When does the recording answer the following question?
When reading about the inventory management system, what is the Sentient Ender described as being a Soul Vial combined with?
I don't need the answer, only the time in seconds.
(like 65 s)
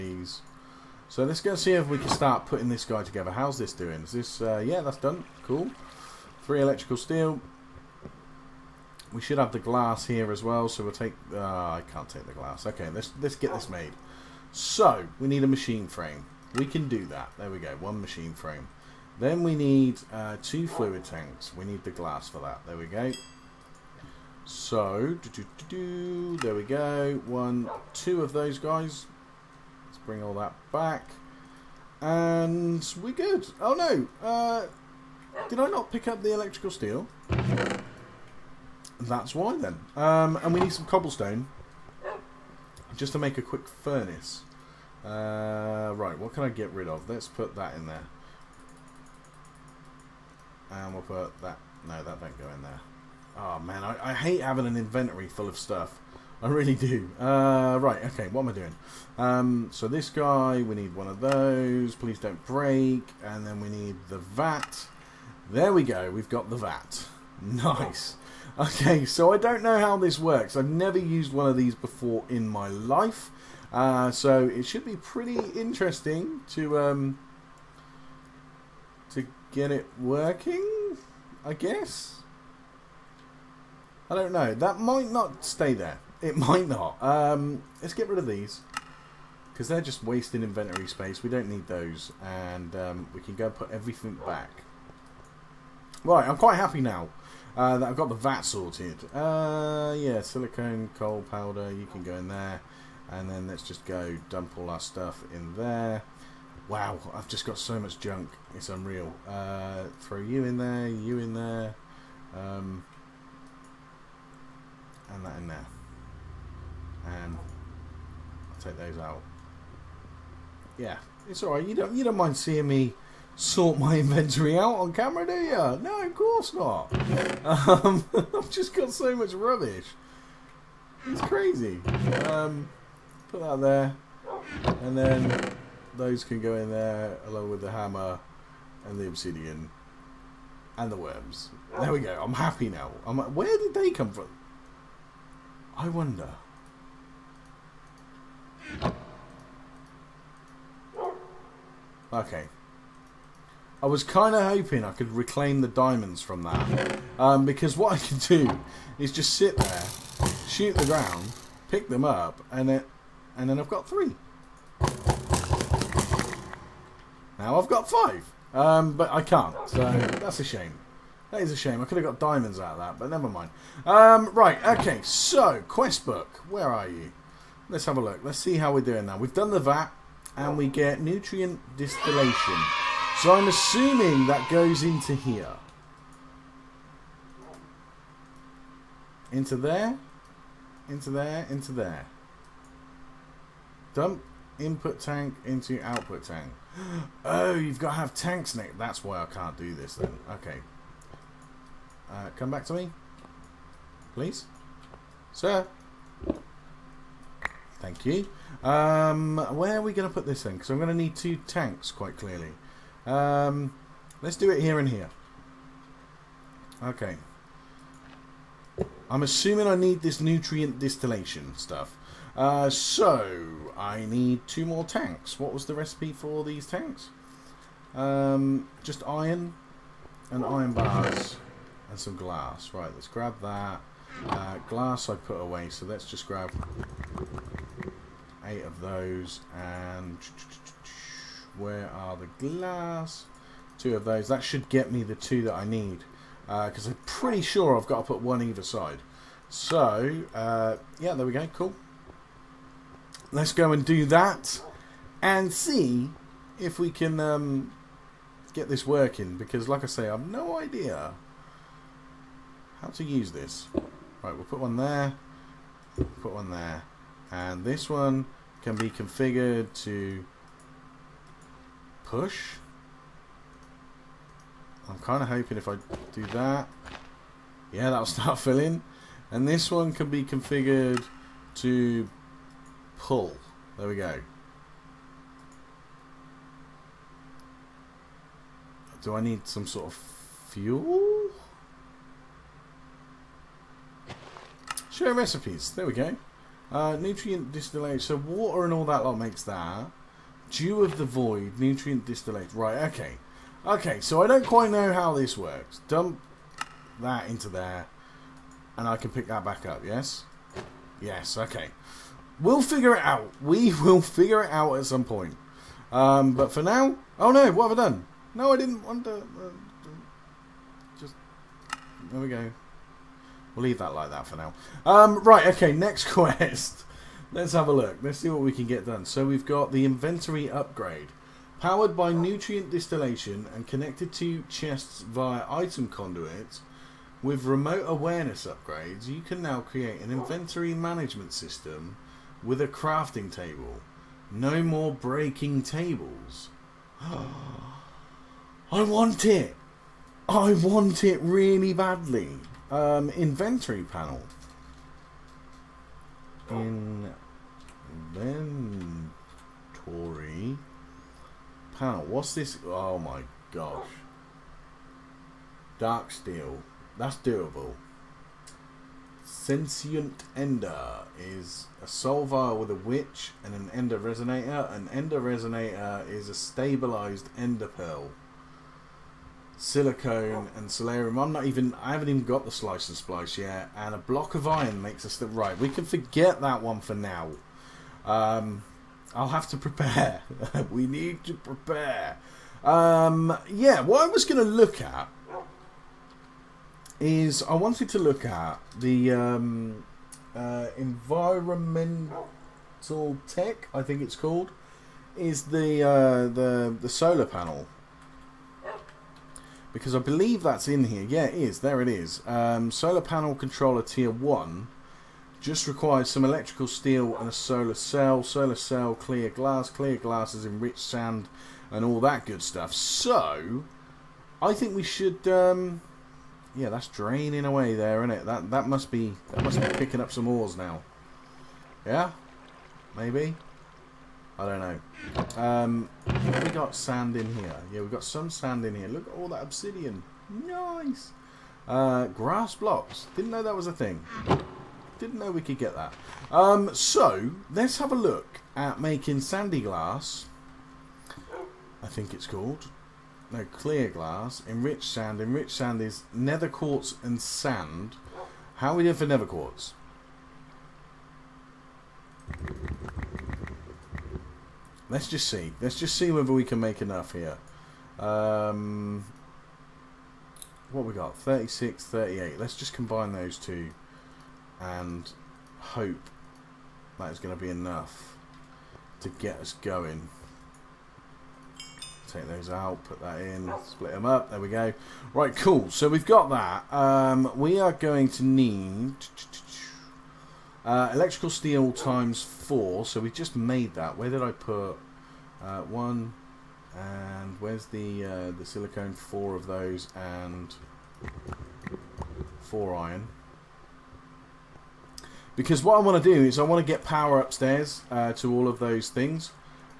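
372 s.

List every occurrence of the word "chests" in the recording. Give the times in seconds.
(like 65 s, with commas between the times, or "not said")
334 s.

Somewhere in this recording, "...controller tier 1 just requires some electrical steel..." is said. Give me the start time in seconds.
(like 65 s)
413 s.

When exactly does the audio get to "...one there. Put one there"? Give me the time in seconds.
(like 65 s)
264 s.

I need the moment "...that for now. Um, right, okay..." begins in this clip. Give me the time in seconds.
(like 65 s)
324 s.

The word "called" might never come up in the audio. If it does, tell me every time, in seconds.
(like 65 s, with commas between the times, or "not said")
404 s, 452 s.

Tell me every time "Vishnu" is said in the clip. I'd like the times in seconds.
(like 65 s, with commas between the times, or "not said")
not said.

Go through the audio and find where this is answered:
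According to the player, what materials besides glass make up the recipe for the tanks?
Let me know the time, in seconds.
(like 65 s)
229 s.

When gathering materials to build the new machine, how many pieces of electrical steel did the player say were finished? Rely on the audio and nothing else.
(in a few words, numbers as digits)
3.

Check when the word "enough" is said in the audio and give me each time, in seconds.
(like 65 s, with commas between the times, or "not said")
466 s, 477 s.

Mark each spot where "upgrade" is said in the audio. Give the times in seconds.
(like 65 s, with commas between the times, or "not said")
330 s, 338 s.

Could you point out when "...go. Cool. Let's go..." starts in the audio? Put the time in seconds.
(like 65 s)
251 s.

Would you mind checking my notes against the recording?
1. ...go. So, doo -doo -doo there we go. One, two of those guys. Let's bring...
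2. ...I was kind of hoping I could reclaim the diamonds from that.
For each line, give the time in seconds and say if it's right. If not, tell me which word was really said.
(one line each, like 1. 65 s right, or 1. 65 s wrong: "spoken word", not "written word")
1. 22 s right
2. 153 s right.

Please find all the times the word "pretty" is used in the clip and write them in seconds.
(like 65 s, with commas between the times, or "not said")
74 s, 247 s.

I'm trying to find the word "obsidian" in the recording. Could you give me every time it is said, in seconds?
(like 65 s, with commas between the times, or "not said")
139 s, 439 s.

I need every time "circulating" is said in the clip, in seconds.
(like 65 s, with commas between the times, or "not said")
not said.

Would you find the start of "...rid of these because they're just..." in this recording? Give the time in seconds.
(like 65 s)
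88 s.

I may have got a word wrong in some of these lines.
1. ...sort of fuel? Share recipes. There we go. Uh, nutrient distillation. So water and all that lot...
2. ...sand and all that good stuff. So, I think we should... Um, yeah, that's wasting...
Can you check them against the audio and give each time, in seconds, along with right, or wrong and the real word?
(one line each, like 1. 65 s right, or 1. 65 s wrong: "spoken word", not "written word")
1. 289 s right
2. 420 s wrong: "draining", not "wasting".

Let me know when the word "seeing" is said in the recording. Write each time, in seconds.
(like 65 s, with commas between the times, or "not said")
122 s.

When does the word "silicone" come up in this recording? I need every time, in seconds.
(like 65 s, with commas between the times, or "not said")
100 s, 379 s, 498 s.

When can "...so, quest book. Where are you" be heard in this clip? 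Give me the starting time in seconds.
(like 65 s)
175 s.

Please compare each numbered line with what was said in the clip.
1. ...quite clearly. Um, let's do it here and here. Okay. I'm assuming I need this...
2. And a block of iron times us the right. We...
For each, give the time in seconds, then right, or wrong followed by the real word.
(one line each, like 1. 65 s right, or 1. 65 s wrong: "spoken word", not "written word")
1. 211 s right
2. 383 s wrong: "makes", not "times".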